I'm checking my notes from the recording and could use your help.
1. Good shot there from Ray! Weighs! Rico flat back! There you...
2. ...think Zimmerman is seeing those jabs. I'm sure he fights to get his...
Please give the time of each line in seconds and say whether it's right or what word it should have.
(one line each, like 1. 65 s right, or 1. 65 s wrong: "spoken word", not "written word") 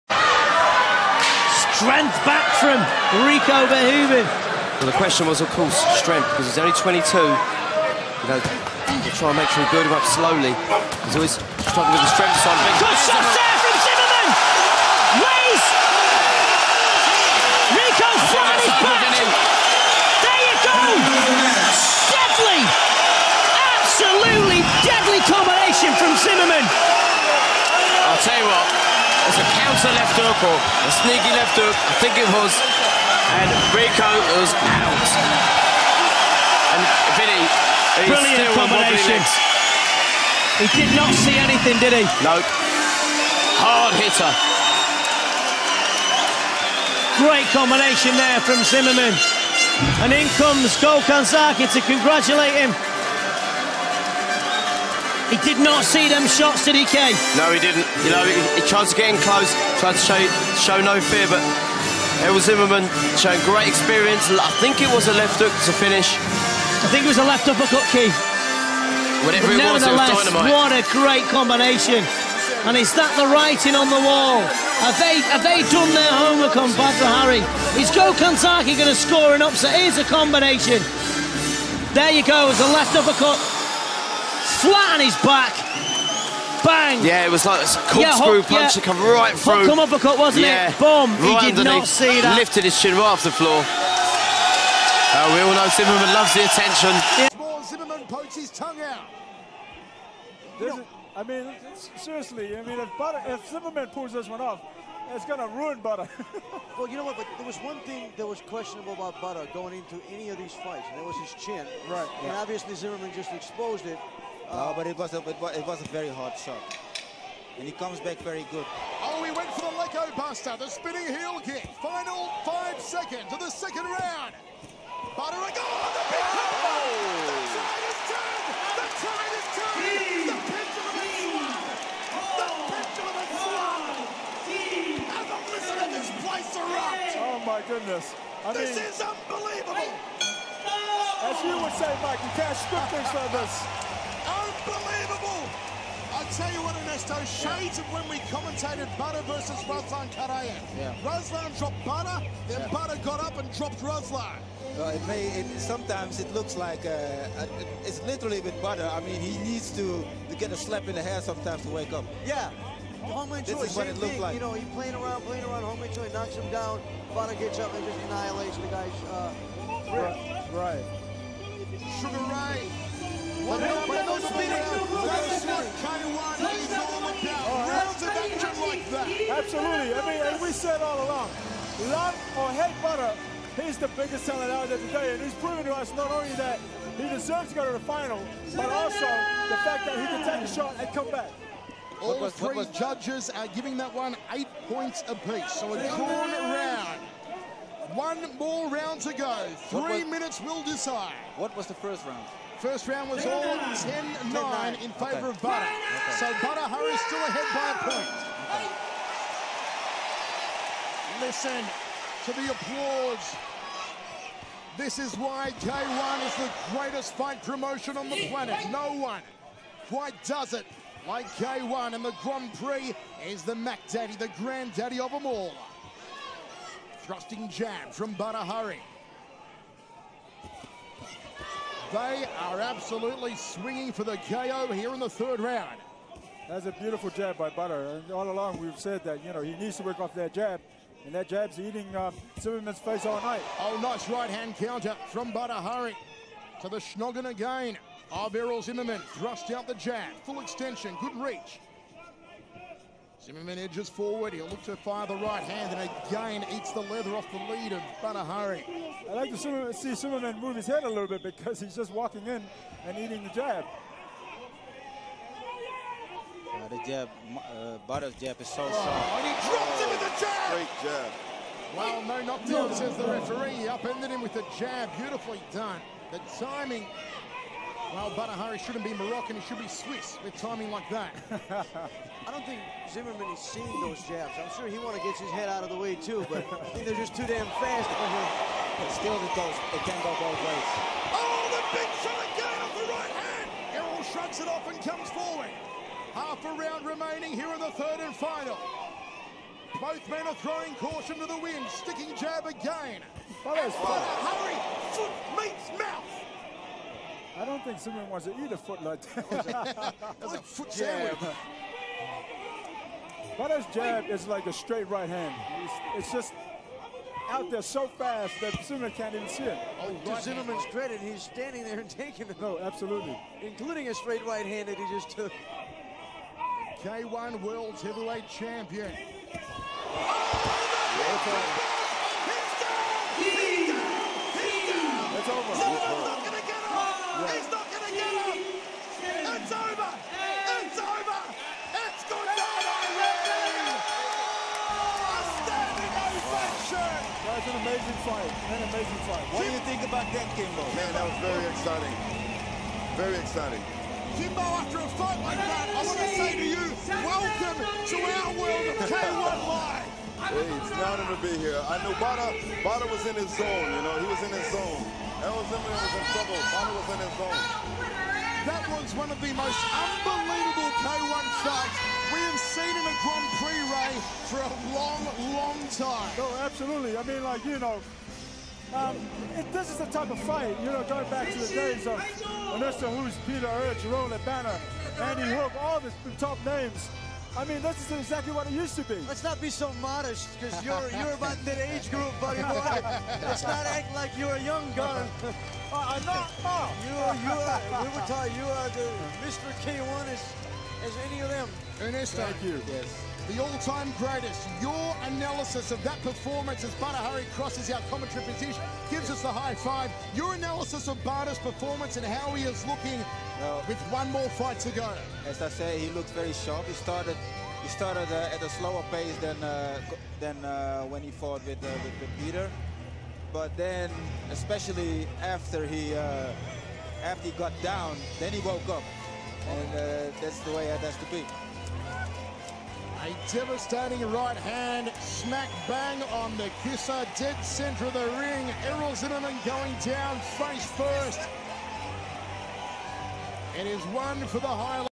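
1. 12 s wrong: "Zimmerman", not "Ray"
2. 282 s wrong: "wants", not "fights".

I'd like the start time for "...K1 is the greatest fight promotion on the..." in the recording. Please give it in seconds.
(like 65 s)
215 s.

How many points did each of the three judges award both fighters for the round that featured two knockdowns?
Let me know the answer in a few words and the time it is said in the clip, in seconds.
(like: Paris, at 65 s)
8, at 194 s.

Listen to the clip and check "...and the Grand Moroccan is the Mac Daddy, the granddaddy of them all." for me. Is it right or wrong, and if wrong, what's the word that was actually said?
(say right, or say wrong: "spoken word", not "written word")
wrong: "Prix", not "Moroccan".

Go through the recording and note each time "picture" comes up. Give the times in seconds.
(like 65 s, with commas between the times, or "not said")
126 s.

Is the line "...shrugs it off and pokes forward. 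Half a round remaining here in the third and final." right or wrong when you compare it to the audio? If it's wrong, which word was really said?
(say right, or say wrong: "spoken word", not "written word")
wrong: "comes", not "pokes".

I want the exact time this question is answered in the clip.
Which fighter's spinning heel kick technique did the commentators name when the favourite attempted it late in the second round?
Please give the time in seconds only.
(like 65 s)
119 s.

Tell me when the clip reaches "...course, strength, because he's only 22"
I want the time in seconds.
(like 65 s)
5 s.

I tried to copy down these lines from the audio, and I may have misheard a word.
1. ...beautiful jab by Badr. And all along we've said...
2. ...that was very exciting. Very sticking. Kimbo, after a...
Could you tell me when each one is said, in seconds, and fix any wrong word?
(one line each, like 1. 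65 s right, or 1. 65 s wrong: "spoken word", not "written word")
1. 236 s right
2. 350 s wrong: "exciting", not "sticking".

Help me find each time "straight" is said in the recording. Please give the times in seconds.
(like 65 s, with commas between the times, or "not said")
314 s, 323 s.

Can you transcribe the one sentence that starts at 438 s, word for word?
Errol Zimmerman going down face first.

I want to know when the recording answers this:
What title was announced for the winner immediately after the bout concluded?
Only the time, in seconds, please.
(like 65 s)
326 s.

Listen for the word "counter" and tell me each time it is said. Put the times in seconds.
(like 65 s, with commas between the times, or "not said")
29 s, 244 s.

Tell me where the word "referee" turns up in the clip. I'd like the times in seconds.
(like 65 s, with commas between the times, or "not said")
273 s.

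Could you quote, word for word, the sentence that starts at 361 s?
I knew Bada, Bada was in his zone, you know, he was in his zone.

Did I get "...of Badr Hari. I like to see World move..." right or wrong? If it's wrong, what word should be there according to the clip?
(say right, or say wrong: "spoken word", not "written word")
wrong: "Zimmerman", not "World".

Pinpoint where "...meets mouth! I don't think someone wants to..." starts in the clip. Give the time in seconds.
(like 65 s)
305 s.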